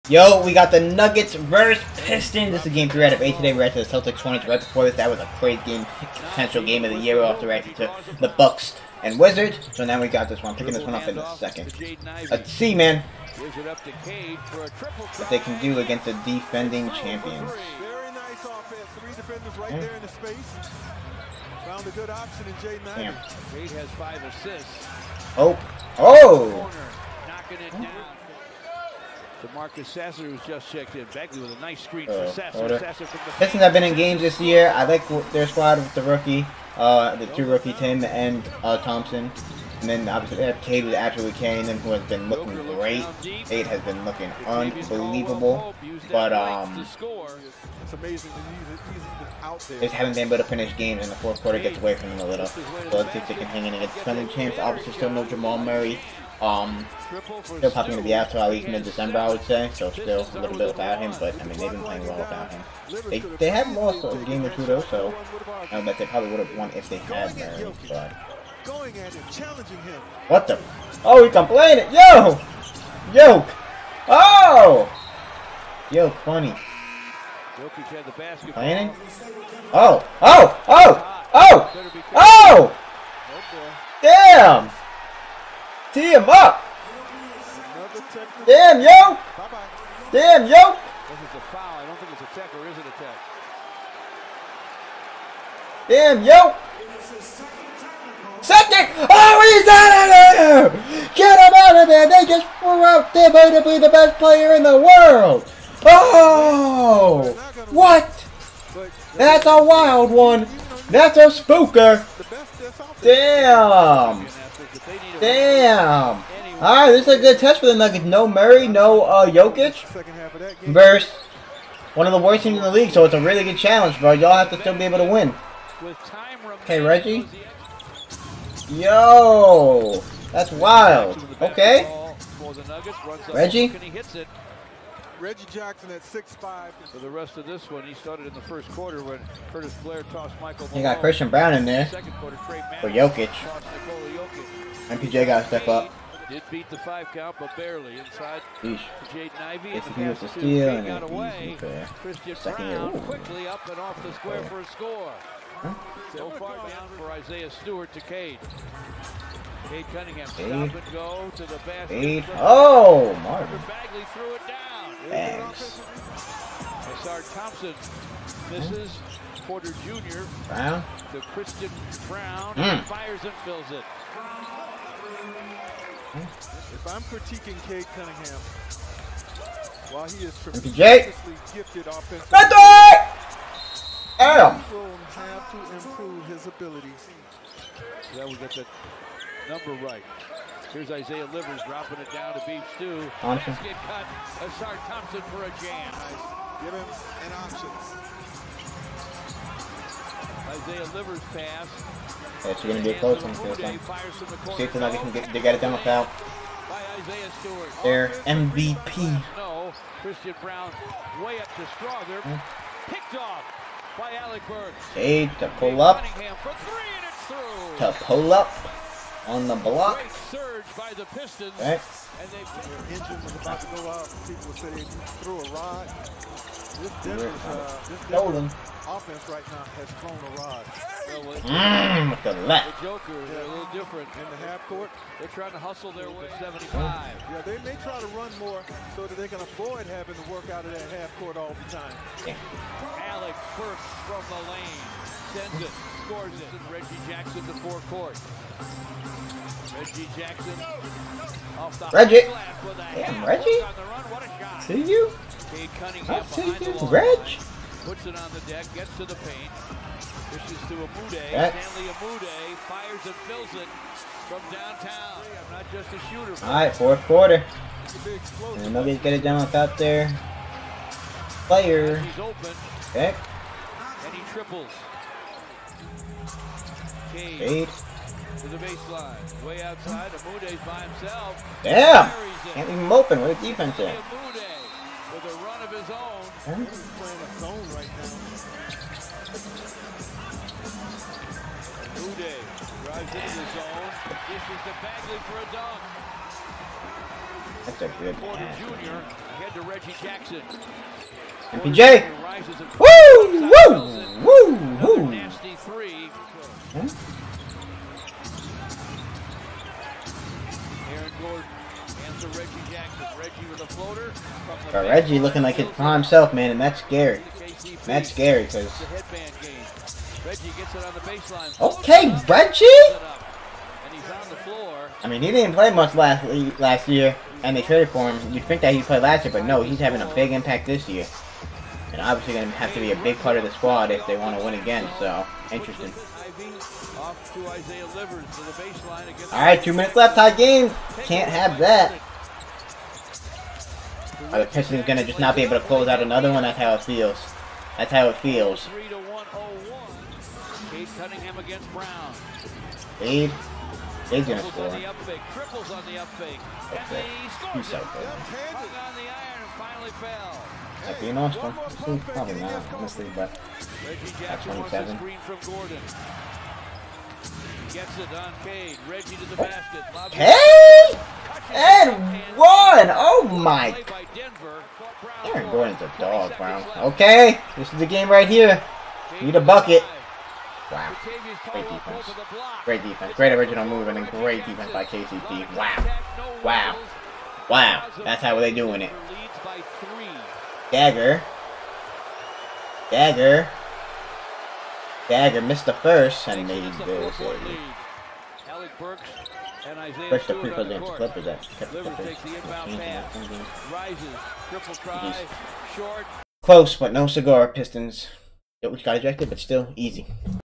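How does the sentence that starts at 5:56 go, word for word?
That's and he scores so on the iron and finally fell.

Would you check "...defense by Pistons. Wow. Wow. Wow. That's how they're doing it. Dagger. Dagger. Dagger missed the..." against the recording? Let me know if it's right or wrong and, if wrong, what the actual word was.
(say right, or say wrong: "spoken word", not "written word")
wrong: "KCP", not "Pistons".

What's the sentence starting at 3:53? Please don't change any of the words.
are a little different in the half court.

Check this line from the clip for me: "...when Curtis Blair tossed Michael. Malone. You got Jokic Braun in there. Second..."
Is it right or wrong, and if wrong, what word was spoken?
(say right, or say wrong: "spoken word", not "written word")
wrong: "Christian", not "Jokic".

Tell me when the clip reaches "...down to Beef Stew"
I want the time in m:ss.
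3:12.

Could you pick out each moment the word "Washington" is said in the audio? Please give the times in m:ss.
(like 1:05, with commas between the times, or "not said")
not said.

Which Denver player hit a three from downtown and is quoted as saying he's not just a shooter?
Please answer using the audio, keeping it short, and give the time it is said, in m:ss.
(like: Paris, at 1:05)
Stanley Umude, at 4:21.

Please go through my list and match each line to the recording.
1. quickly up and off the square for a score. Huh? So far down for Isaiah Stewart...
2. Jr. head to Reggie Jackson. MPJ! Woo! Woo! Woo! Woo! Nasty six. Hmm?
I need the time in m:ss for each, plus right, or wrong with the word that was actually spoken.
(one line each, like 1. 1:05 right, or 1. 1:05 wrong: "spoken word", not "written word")
1. 2:33 right
2. 4:58 wrong: "three", not "six".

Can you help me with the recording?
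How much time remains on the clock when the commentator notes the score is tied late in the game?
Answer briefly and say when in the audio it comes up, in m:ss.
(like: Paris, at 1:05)
2 minutes, at 5:39.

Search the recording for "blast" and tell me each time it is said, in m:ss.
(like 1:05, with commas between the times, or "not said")
not said.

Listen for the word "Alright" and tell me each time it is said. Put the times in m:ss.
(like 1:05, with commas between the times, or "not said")
1:56, 5:39.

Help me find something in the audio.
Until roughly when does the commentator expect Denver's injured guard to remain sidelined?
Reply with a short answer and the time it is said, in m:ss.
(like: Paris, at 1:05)
mid-December, at 0:58.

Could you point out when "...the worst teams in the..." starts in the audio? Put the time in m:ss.
2:02.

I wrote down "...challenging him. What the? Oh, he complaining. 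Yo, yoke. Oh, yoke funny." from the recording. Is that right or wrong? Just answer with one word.
right.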